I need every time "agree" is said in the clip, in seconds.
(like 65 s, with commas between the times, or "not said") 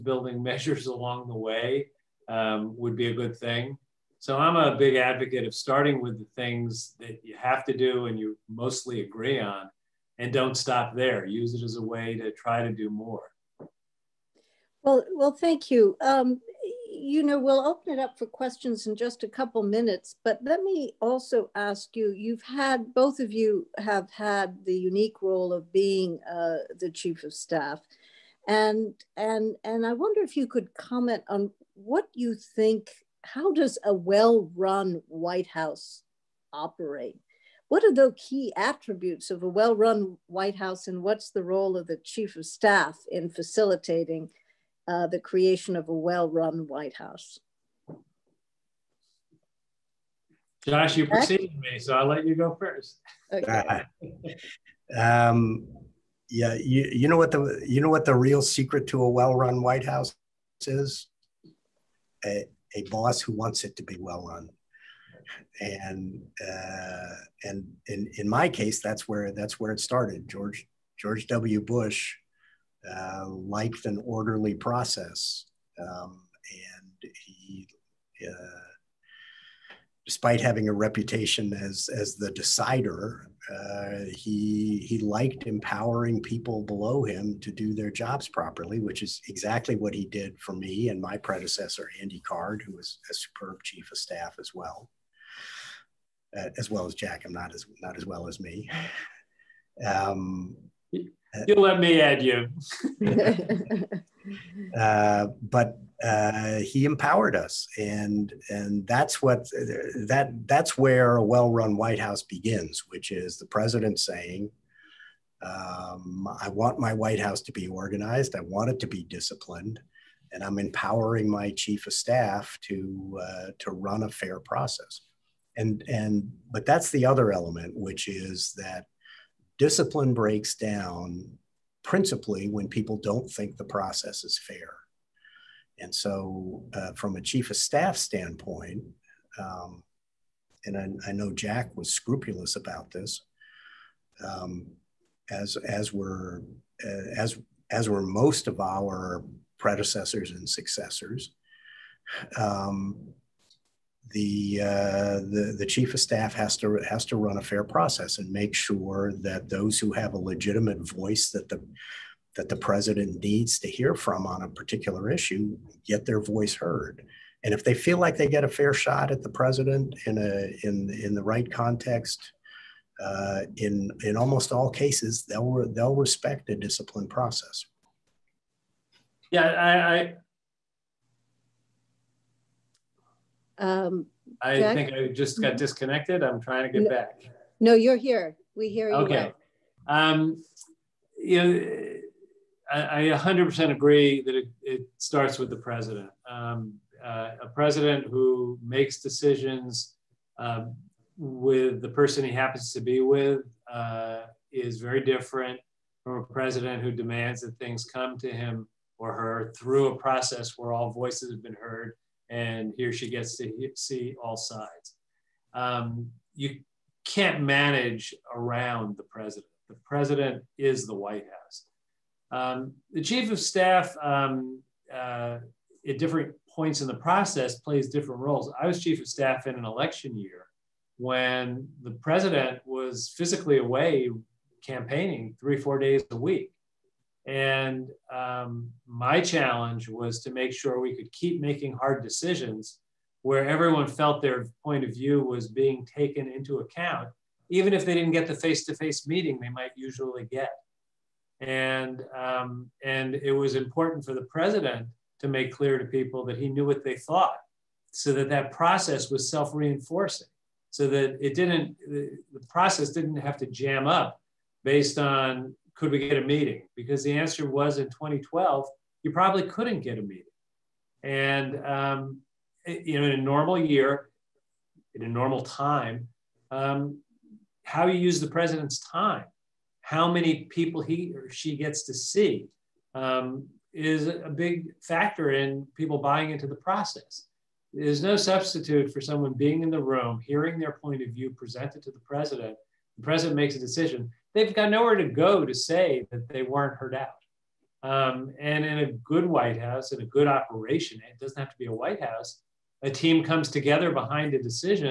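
9 s, 193 s.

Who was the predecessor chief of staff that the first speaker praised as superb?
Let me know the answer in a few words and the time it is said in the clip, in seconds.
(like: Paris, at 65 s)
Andy Card, at 91 s.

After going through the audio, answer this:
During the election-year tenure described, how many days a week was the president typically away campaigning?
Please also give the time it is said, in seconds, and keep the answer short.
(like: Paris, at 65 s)
3 or 4, at 235 s.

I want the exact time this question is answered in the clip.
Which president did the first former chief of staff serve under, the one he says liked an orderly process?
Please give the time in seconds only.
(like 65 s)
70 s.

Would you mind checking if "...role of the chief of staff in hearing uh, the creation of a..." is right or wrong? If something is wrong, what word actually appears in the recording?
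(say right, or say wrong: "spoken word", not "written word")
wrong: "facilitating", not "hearing".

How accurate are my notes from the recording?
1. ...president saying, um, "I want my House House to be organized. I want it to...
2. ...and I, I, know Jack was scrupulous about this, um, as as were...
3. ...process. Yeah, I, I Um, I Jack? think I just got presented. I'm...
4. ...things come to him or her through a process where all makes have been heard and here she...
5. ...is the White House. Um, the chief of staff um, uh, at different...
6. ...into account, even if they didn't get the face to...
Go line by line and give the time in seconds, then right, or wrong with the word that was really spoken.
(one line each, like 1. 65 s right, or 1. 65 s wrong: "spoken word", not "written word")
1. 113 s wrong: "White", not "House"
2. 140 s right
3. 177 s wrong: "disconnected", not "presented"
4. 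207 s wrong: "voices", not "makes"
5. 220 s right
6. 246 s right.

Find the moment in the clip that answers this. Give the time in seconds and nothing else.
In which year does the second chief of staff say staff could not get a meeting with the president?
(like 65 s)
267 s.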